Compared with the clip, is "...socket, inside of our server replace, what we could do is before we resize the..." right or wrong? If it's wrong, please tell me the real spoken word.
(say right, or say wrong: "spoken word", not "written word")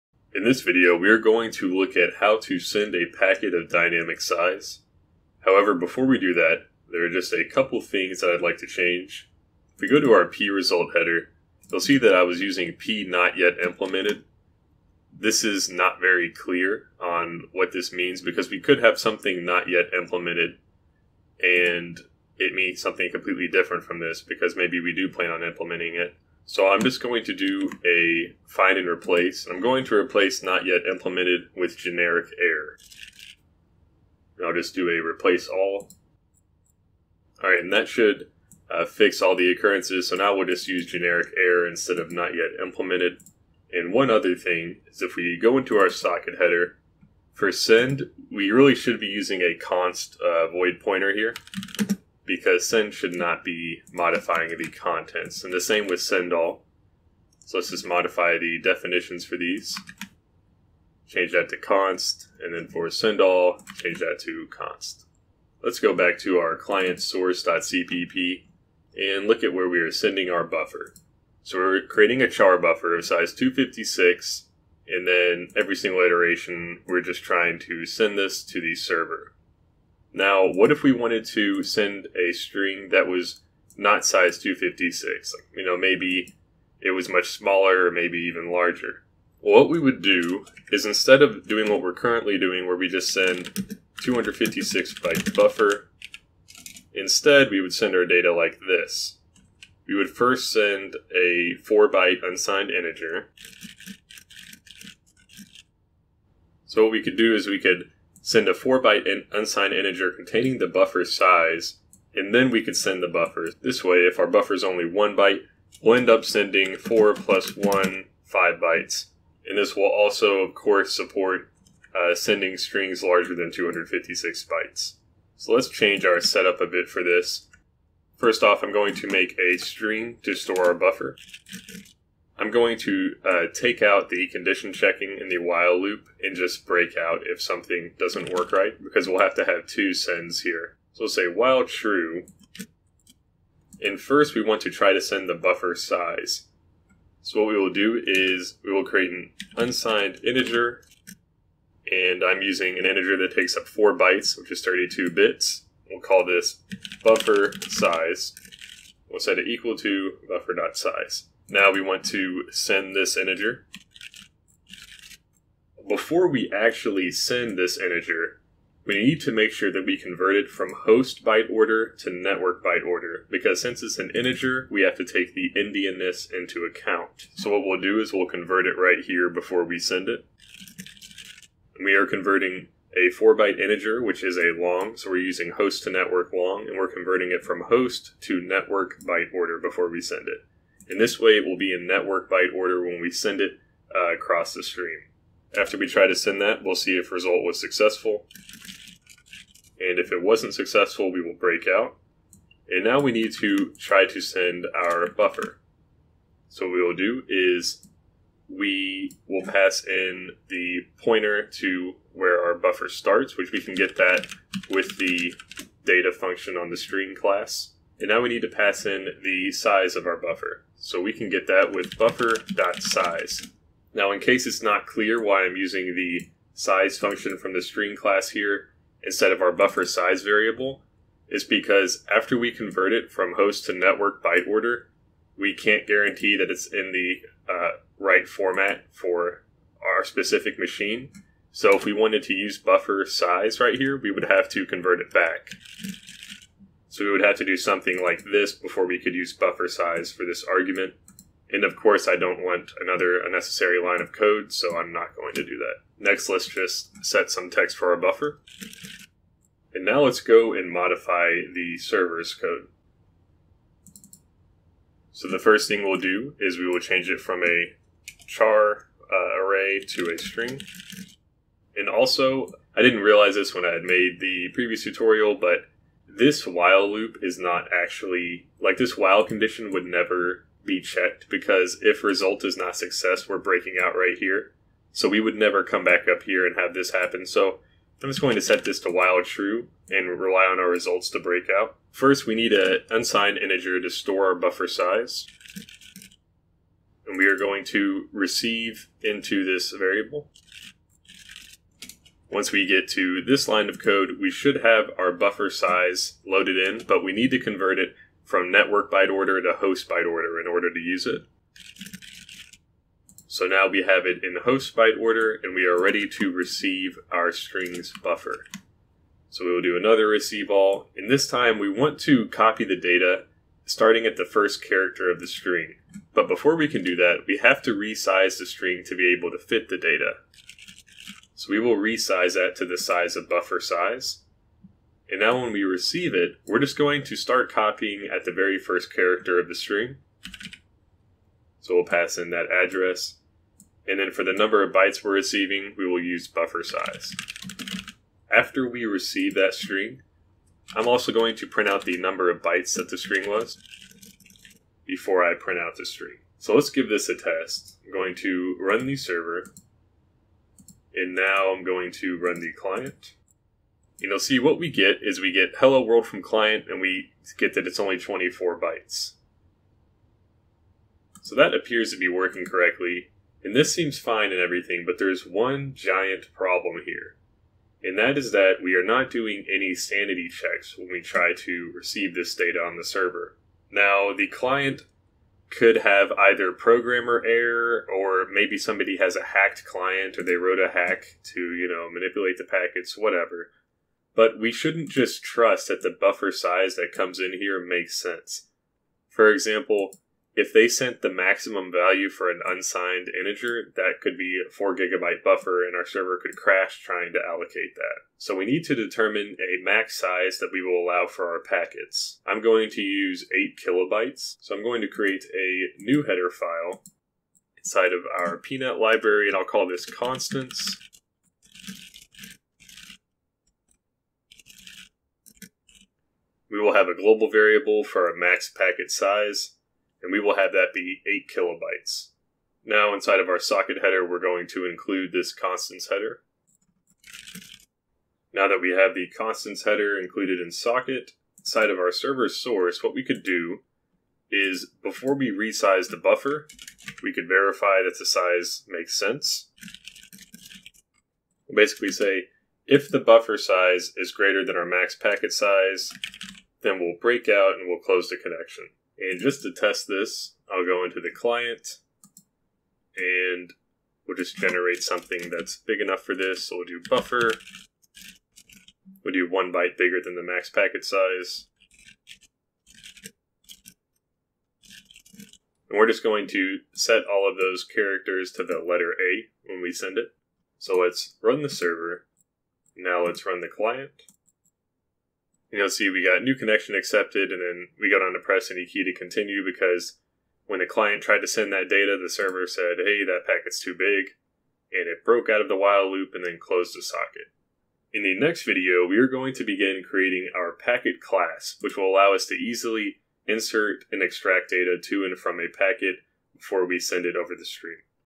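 wrong: "source", not "replace".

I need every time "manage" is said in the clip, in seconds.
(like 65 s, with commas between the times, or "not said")
not said.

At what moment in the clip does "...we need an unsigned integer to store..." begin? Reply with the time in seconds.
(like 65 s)
292 s.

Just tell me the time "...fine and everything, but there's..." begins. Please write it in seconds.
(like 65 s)
373 s.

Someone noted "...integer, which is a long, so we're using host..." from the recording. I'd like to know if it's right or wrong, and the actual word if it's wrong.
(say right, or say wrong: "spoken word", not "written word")
right.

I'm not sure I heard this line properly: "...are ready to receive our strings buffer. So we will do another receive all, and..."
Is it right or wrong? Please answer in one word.
right.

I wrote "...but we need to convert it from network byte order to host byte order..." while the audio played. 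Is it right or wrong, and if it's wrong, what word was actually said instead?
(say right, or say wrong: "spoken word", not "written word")
right.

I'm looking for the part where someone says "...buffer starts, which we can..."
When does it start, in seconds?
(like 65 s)
212 s.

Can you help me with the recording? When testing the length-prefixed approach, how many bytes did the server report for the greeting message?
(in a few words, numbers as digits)
24.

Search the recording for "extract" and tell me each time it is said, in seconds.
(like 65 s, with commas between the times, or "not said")
504 s.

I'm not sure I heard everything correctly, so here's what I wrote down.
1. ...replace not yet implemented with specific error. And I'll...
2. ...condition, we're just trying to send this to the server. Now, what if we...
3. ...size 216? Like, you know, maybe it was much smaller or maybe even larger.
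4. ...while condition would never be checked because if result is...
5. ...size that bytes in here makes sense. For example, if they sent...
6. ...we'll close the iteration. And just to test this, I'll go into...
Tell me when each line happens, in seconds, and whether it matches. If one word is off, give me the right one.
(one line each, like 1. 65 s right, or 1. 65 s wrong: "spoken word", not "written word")
1. 29 s wrong: "generic", not "specific"
2. 75 s wrong: "iteration", not "condition"
3. 84 s wrong: "256", not "216"
4. 278 s right
5. 396 s wrong: "comes", not "bytes"
6. 457 s wrong: "connection", not "iteration".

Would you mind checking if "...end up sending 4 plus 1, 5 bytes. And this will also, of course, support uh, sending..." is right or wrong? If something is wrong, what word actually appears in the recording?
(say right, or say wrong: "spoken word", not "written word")
right.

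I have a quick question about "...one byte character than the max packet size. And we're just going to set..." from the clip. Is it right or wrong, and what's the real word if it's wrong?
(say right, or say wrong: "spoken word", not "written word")
wrong: "bigger", not "character".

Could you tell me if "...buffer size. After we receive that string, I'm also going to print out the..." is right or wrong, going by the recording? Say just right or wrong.
right.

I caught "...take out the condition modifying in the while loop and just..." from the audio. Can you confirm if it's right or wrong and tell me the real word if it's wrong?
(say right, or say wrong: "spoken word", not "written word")
wrong: "checking", not "modifying".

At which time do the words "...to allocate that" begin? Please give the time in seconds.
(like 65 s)
407 s.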